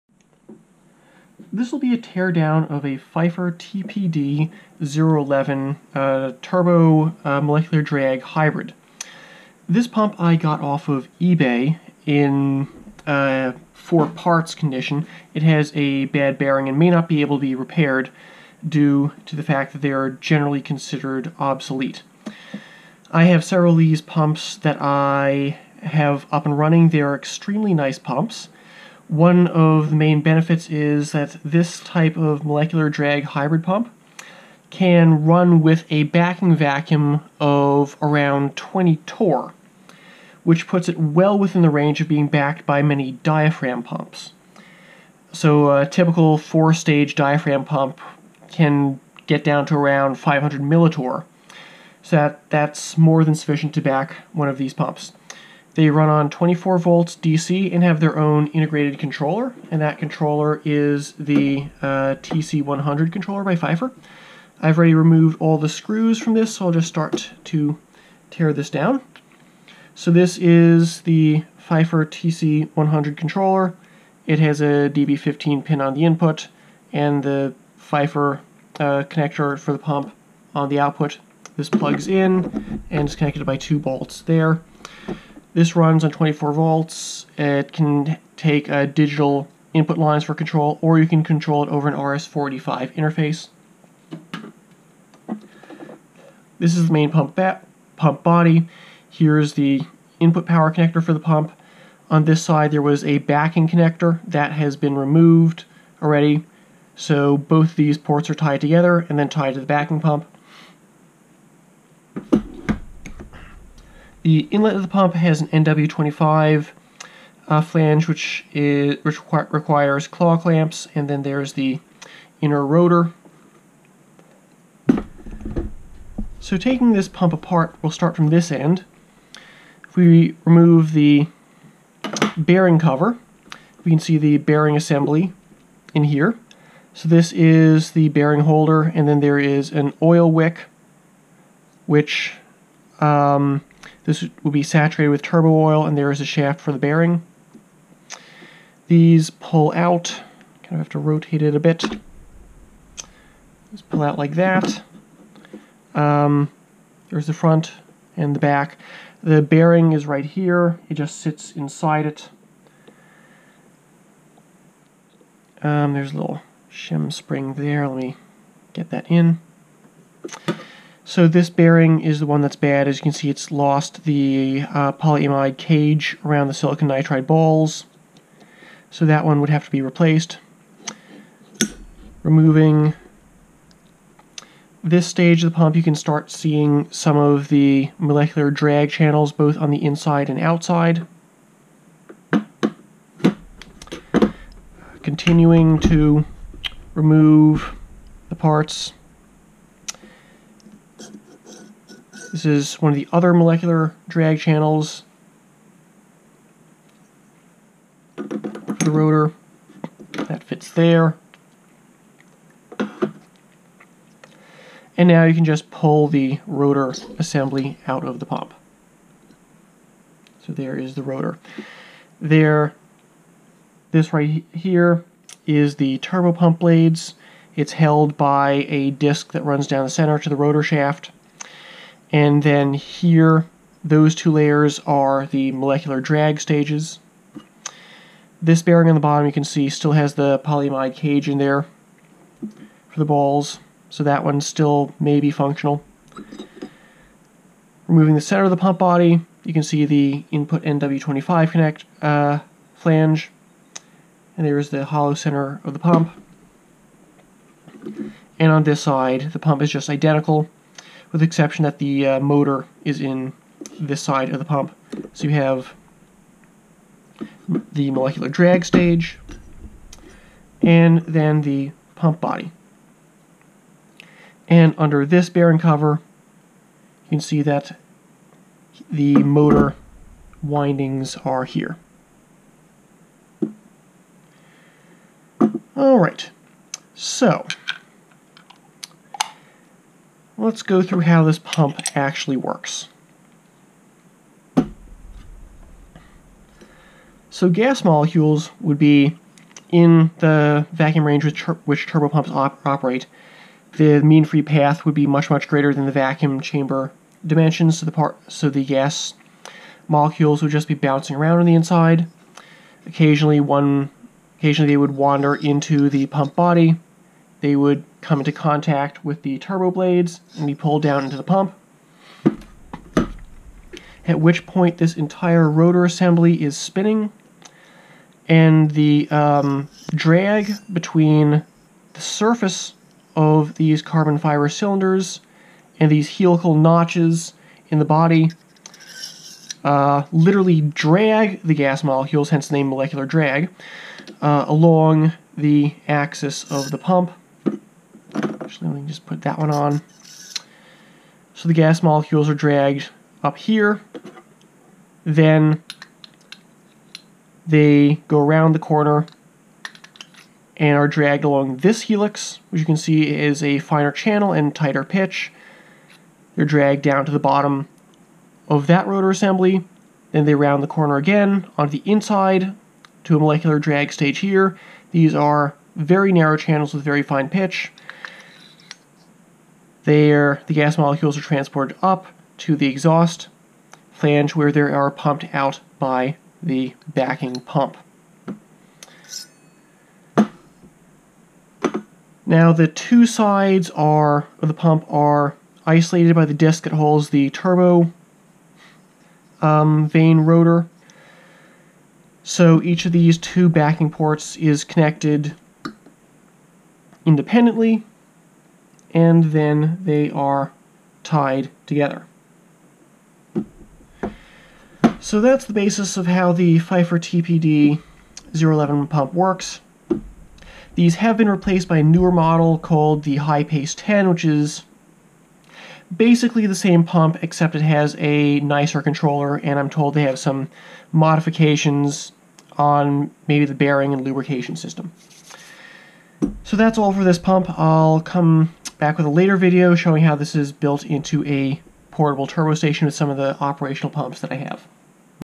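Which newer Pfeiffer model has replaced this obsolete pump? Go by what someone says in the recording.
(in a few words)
HiPace 10.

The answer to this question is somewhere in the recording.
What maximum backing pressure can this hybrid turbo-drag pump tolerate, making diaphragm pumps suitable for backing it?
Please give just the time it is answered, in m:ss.
0:38.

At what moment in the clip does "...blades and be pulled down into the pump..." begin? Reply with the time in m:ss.
5:19.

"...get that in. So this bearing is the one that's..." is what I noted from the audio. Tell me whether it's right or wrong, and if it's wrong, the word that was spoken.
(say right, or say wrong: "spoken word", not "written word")
right.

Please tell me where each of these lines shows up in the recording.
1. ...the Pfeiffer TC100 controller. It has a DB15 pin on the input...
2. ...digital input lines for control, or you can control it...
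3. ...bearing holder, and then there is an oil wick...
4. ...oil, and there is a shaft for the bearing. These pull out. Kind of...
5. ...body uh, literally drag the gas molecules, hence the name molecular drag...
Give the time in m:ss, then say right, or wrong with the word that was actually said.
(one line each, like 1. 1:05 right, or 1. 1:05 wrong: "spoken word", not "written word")
1. 1:11 right
2. 1:28 right
3. 2:18 right
4. 2:25 right
5. 5:37 right.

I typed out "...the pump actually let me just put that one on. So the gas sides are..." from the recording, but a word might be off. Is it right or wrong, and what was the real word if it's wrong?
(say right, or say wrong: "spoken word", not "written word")
wrong: "molecules", not "sides".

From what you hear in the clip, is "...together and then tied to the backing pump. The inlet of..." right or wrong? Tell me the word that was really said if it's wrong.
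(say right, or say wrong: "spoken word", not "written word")
right.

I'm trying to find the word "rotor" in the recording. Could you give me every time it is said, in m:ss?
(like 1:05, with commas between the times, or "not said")
2:02, 3:28, 3:36, 3:41, 3:50, 5:25, 6:08, 6:40.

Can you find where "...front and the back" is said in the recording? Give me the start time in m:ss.
2:37.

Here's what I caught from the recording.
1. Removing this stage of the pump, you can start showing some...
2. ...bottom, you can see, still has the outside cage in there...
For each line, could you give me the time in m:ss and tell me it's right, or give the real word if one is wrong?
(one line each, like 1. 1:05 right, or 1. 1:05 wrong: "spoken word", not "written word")
1. 3:02 wrong: "seeing", not "showing"
2. 3:59 wrong: "polyamide", not "outside".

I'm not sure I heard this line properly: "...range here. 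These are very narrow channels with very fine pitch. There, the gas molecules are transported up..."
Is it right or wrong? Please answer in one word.
wrong.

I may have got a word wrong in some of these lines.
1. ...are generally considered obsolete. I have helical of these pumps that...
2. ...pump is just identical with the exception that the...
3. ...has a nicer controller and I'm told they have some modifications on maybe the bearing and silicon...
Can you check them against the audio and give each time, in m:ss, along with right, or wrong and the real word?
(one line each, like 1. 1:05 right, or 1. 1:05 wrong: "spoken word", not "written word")
1. 0:19 wrong: "several", not "helical"
2. 4:19 right
3. 7:07 wrong: "lubrication", not "silicon".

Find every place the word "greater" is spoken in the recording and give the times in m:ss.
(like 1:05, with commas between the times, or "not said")
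5:05.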